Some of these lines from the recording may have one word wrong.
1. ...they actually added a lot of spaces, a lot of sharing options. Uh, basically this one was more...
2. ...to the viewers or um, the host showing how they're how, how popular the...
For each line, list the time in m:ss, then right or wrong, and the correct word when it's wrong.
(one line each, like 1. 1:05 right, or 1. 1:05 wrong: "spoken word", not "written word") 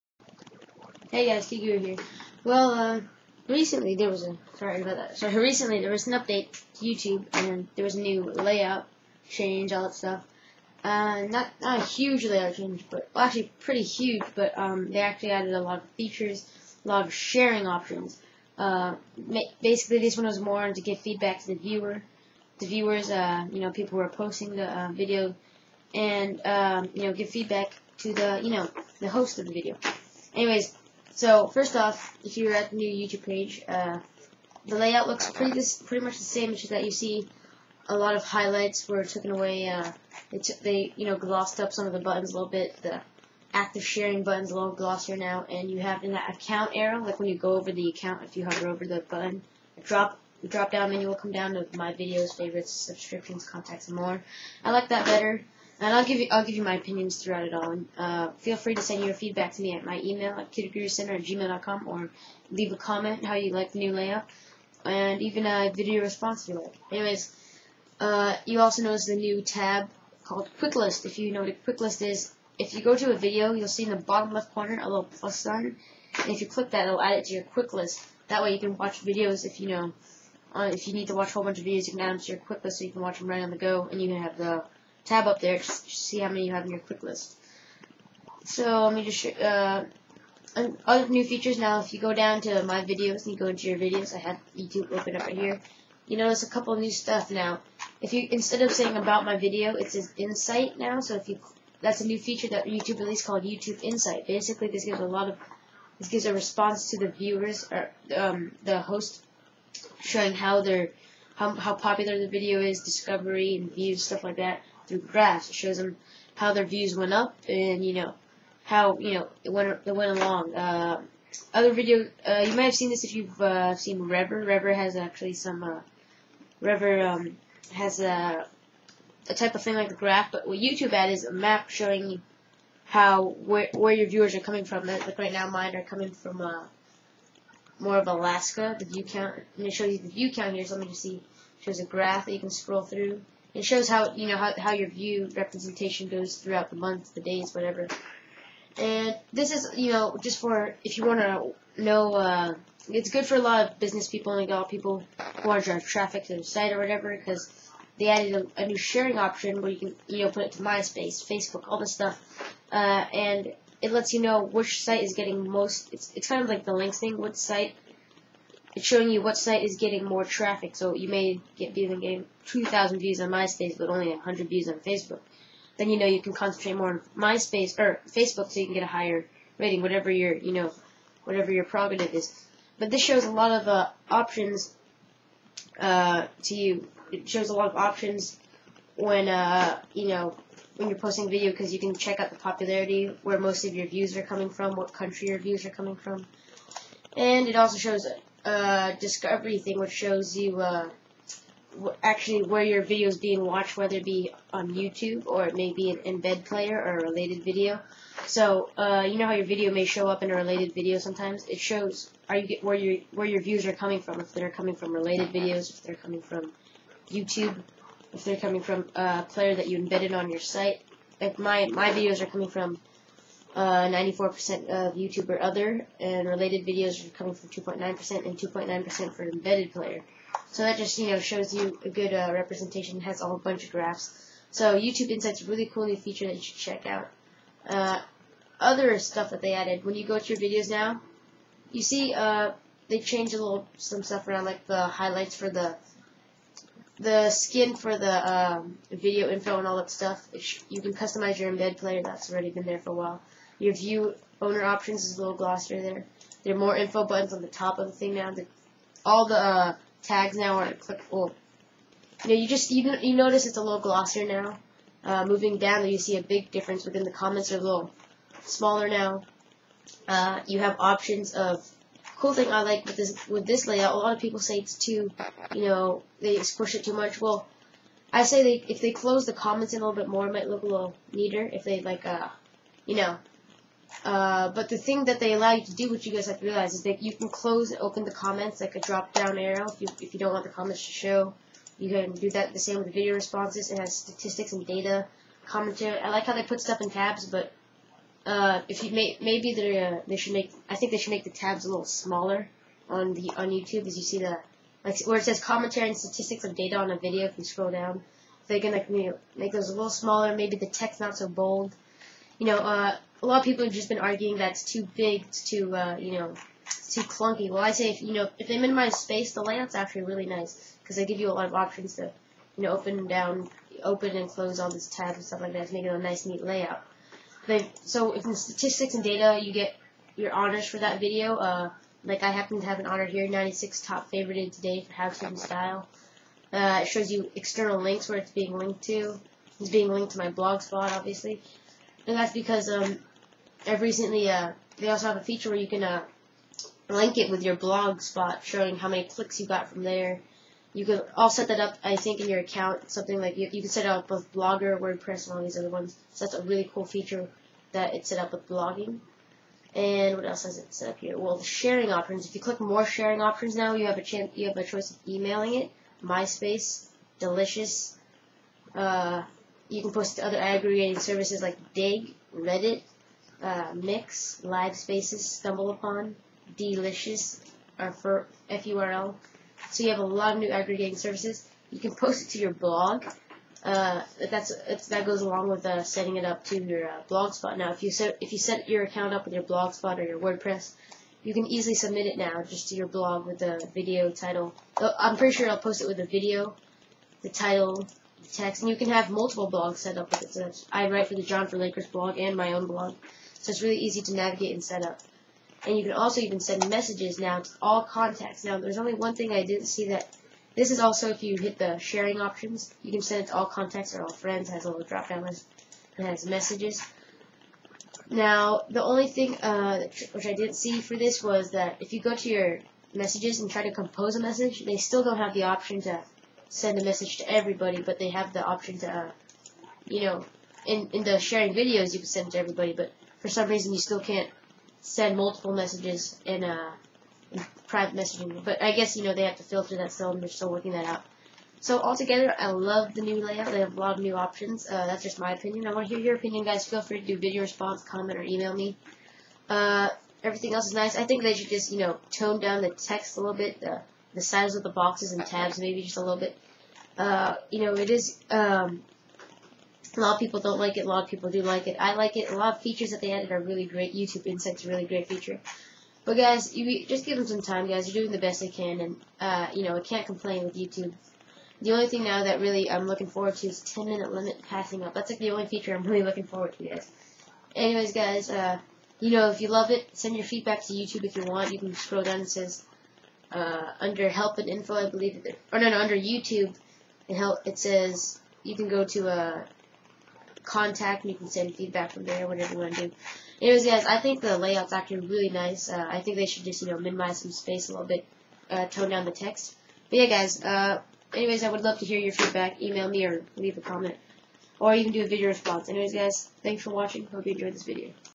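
1. 0:14 wrong: "features", not "spaces"
2. 1:46 right.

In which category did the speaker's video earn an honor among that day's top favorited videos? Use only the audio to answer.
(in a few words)
How to style.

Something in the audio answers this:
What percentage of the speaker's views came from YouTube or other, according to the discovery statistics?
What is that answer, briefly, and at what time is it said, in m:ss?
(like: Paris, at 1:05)
94%, at 3:43.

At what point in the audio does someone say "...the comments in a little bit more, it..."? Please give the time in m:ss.
4:39.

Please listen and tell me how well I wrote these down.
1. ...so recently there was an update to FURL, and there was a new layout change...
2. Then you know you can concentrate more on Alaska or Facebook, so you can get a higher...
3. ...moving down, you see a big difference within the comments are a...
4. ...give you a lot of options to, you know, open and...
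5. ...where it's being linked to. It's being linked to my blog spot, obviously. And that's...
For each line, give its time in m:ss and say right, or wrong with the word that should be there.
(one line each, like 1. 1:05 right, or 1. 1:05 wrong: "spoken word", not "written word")
1. 0:05 wrong: "YouTube", not "FURL"
2. 2:55 wrong: "MySpace", not "Alaska"
3. 4:25 right
4. 5:21 right
5. 5:38 right.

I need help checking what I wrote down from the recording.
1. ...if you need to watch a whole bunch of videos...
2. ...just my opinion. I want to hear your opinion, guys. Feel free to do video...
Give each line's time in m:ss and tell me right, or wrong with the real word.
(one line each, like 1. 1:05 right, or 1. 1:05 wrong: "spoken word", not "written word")
1. 1:20 right
2. 7:25 right.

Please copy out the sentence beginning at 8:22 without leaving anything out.
Email me or leave a comment.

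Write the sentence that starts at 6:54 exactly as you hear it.
It has a little drop down list and has messages.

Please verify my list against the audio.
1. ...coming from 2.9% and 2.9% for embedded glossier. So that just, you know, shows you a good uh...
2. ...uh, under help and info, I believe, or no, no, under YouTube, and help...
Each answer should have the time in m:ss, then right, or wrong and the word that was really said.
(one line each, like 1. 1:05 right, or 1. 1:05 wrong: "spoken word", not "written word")
1. 3:47 wrong: "player", not "glossier"
2. 8:03 right.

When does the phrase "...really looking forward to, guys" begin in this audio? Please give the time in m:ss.
7:55.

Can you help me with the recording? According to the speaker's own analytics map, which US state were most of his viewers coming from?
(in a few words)
Alaska.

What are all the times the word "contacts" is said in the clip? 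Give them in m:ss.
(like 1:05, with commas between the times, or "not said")
0:53, 6:47, 6:53, 8:10.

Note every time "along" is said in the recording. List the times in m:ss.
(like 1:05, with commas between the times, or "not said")
2:00, 6:25.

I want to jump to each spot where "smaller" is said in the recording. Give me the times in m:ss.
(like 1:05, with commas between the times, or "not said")
4:28, 5:01, 5:09.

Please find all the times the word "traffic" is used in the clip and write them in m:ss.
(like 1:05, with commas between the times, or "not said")
2:35, 2:50.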